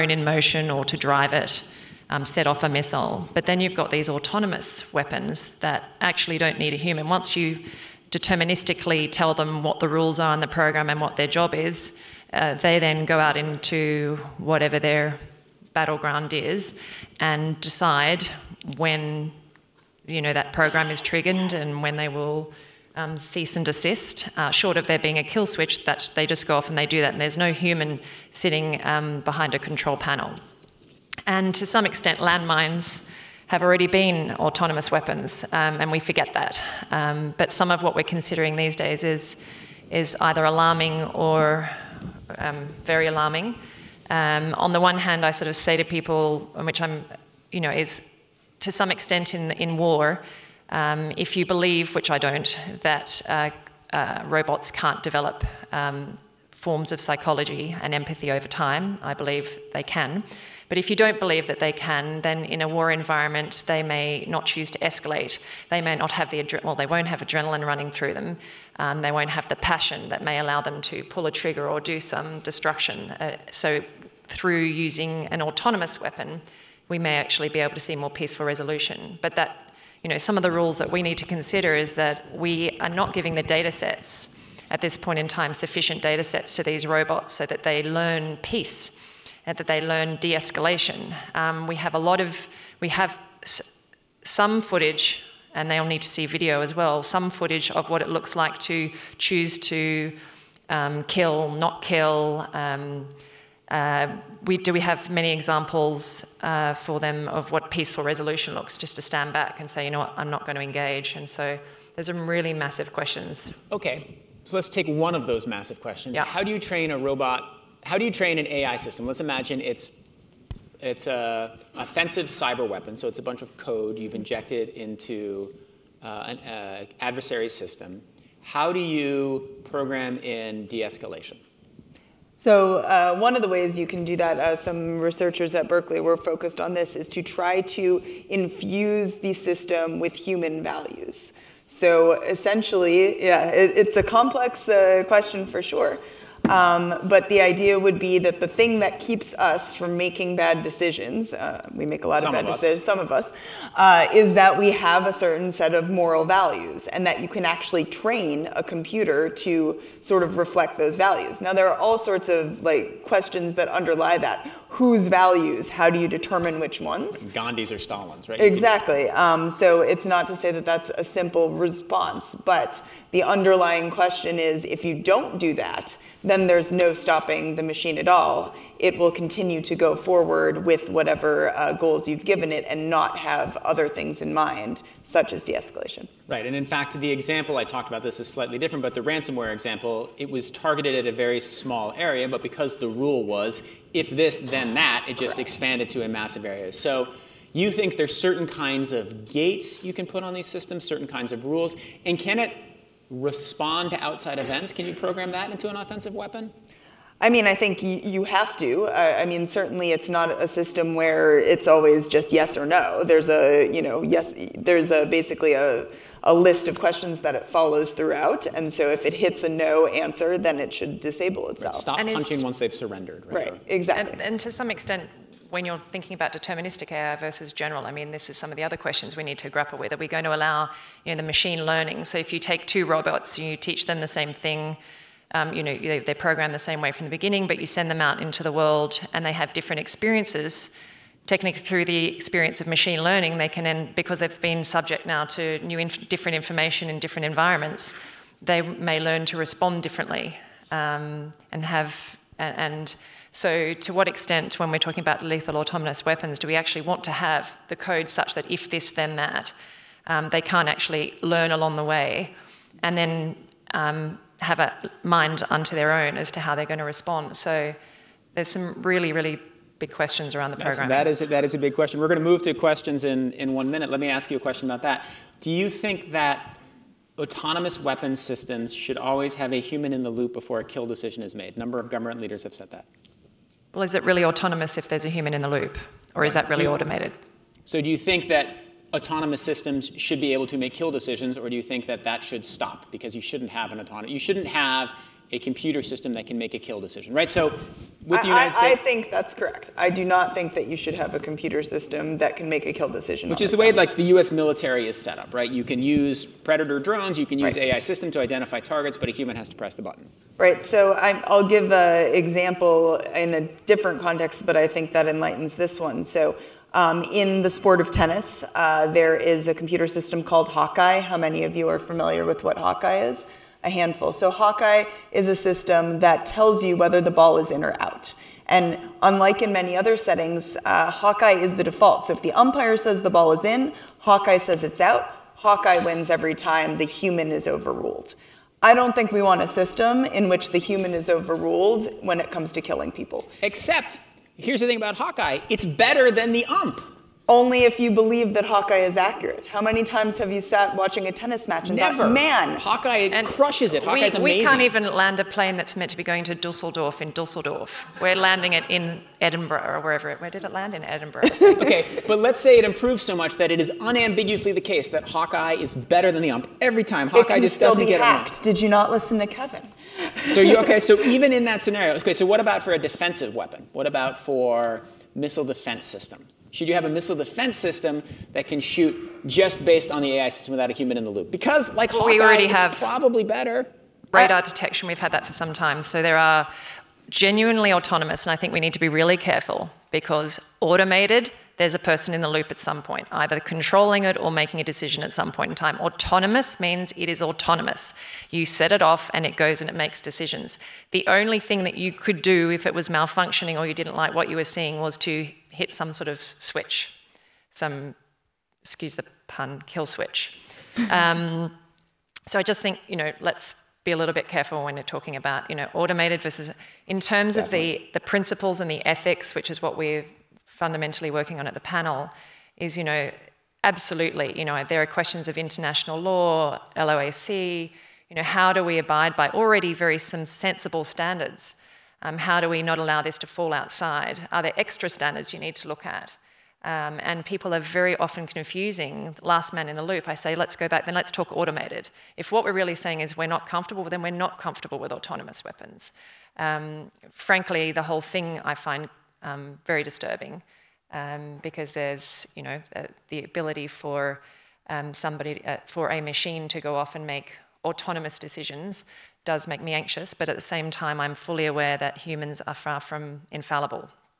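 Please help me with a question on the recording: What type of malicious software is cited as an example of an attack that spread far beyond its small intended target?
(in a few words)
Ransomware.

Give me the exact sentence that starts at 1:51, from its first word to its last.
And so there's some really massive questions.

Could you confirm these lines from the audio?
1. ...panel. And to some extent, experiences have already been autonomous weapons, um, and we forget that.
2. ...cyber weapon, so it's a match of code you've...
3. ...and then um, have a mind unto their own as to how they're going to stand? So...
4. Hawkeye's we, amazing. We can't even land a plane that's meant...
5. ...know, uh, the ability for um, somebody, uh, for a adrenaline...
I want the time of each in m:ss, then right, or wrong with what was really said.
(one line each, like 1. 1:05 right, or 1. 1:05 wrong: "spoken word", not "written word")
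1. 0:29 wrong: "landmines", not "experiences"
2. 2:02 wrong: "bunch", not "match"
3. 4:22 wrong: "respond", not "stand"
4. 5:53 right
5. 7:32 wrong: "machine", not "adrenaline".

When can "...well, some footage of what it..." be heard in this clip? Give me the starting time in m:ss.
1:36.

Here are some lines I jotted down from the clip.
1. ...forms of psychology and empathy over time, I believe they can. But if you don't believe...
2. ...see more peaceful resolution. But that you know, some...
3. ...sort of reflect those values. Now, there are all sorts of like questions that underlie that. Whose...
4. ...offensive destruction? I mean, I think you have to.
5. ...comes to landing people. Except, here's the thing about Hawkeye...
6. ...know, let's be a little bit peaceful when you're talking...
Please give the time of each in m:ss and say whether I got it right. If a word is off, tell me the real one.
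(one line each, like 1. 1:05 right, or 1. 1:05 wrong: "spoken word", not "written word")
1. 0:56 right
2. 1:17 right
3. 2:39 right
4. 3:25 wrong: "weapon", not "destruction"
5. 5:42 wrong: "killing", not "landing"
6. 6:52 wrong: "careful", not "peaceful".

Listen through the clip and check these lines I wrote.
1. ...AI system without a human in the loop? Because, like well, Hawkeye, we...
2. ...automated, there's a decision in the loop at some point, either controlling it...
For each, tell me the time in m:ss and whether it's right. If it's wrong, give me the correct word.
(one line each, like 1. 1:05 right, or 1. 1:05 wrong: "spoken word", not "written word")
1. 6:20 right
2. 6:30 wrong: "person", not "decision".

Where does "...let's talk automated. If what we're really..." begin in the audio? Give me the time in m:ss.
7:20.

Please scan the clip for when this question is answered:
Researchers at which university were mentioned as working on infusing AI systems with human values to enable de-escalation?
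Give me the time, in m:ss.
2:15.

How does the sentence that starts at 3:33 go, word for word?
There's a, you know, yes, there's a basically a, a list of questions that it follows throughout.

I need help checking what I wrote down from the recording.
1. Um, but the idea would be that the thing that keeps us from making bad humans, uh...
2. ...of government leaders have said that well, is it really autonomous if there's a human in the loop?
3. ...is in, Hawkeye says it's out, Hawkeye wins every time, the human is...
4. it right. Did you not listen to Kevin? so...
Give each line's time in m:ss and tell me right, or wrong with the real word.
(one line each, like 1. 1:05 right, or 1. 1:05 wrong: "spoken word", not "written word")
1. 2:26 wrong: "decisions", not "humans"
2. 4:41 right
3. 5:33 right
4. 6:08 right.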